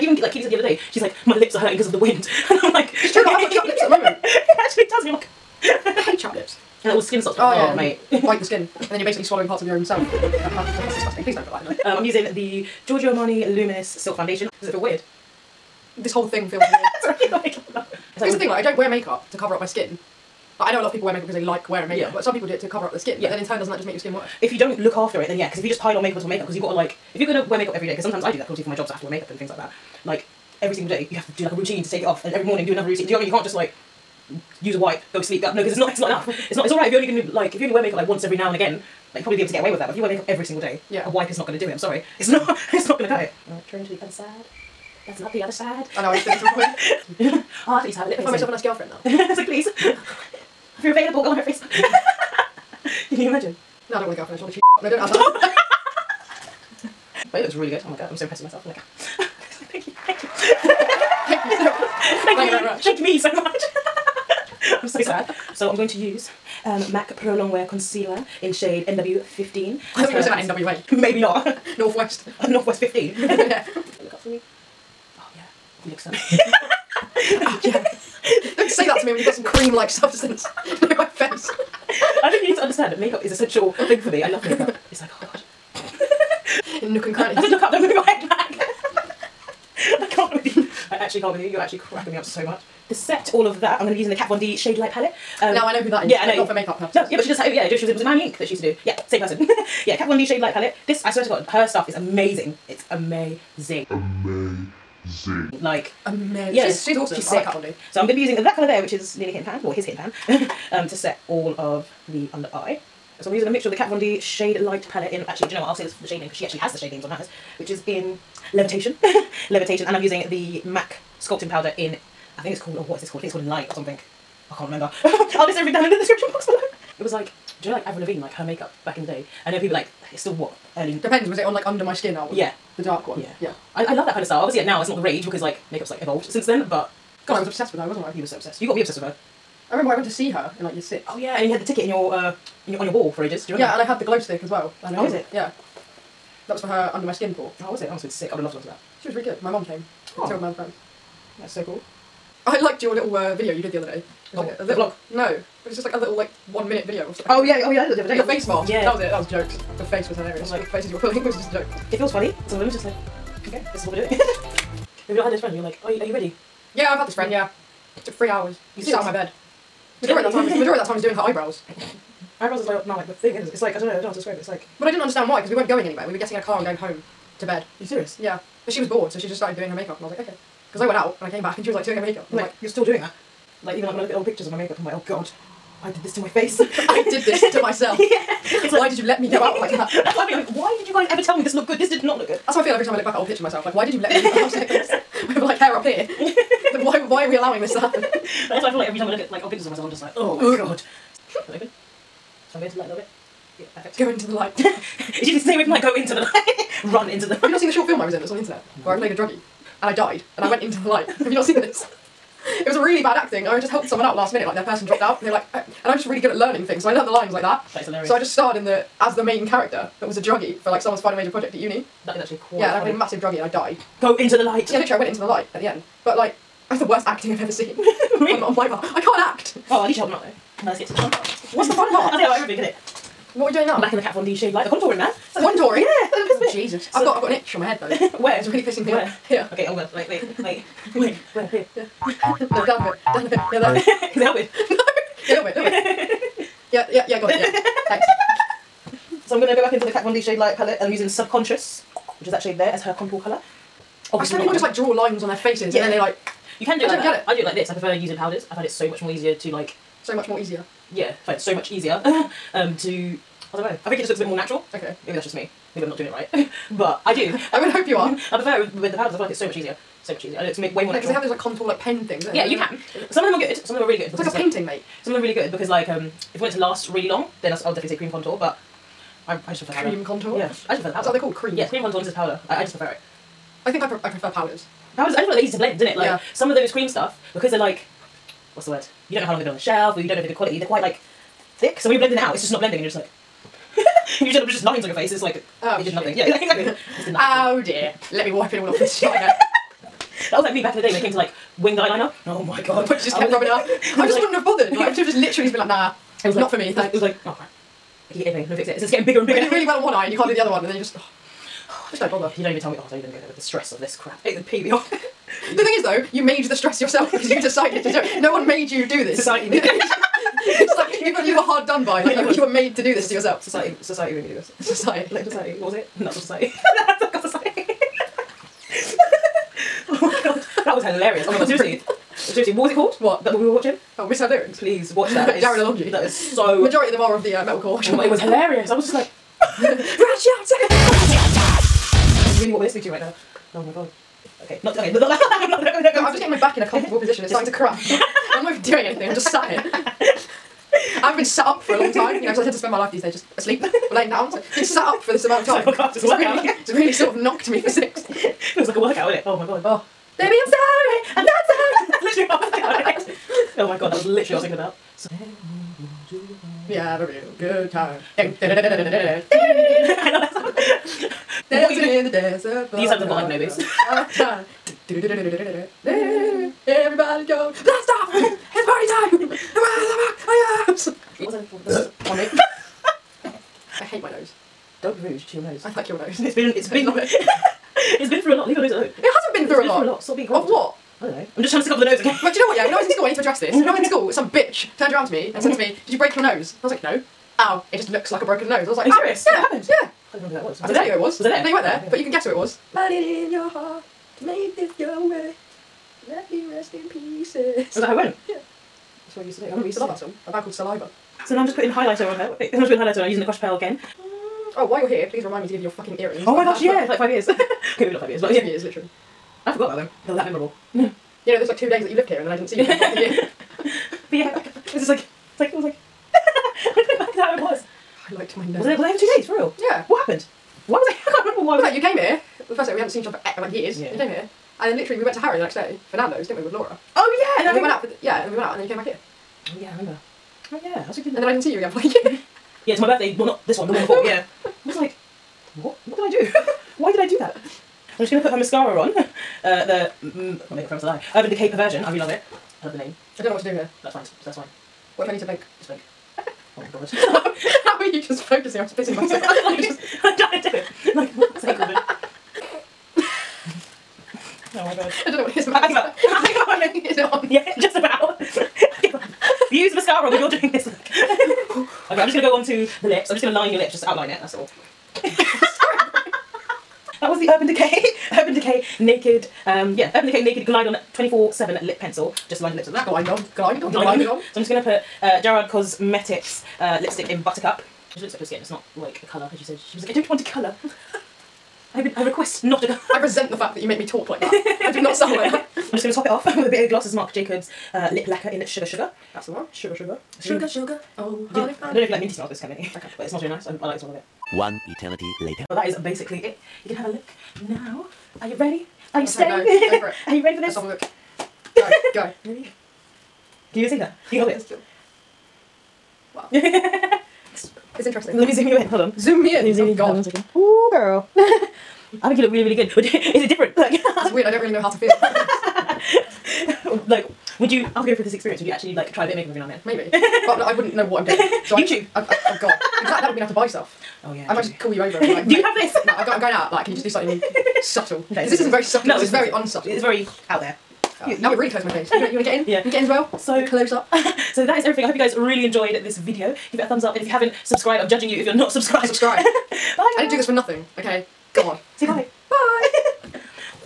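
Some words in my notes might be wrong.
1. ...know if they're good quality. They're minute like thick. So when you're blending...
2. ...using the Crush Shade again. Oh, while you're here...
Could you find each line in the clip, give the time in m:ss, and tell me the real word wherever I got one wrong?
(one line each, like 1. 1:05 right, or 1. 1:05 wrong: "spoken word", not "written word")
1. 4:50 wrong: "quite", not "minute"
2. 6:53 wrong: "Pearl", not "Shade".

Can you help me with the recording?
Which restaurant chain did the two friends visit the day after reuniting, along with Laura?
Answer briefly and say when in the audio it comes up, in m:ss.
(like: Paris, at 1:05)
Nando's, at 7:15.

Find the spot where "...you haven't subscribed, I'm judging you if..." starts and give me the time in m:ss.
9:07.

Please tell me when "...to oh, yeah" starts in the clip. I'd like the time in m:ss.
0:07.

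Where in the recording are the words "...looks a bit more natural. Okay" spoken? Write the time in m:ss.
4:24.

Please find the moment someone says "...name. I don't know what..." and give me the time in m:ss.
7:32.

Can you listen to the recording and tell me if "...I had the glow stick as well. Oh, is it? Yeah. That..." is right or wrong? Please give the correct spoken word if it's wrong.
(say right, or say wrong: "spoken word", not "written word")
right.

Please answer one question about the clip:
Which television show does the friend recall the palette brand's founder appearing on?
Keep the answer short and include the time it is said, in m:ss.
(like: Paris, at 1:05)
Miami Ink, at 1:38.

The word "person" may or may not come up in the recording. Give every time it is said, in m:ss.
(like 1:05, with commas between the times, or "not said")
1:39, 3:34.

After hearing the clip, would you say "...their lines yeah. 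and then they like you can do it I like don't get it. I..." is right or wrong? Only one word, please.
wrong.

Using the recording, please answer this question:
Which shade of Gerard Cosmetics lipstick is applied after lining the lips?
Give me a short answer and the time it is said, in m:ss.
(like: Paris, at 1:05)
Buttercup, at 8:07.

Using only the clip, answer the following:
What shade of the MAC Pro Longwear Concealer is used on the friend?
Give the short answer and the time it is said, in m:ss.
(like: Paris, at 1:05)
NW15, at 1:08.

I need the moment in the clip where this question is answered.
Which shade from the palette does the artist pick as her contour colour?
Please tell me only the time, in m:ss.
4:11.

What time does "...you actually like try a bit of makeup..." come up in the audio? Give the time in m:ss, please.
8:48.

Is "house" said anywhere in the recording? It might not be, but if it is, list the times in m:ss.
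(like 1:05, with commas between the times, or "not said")
3:14.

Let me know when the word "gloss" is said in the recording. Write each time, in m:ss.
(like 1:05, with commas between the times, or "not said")
8:16.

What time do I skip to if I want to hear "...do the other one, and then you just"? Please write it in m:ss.
5:10.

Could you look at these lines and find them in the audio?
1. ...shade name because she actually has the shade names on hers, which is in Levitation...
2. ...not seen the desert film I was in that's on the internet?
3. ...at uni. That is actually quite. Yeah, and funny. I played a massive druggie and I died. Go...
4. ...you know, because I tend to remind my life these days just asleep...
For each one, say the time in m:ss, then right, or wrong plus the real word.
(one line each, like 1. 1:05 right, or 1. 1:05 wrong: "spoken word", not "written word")
1. 1:56 right
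2. 3:27 wrong: "short", not "desert"
3. 3:41 right
4. 5:52 wrong: "spend", not "remind".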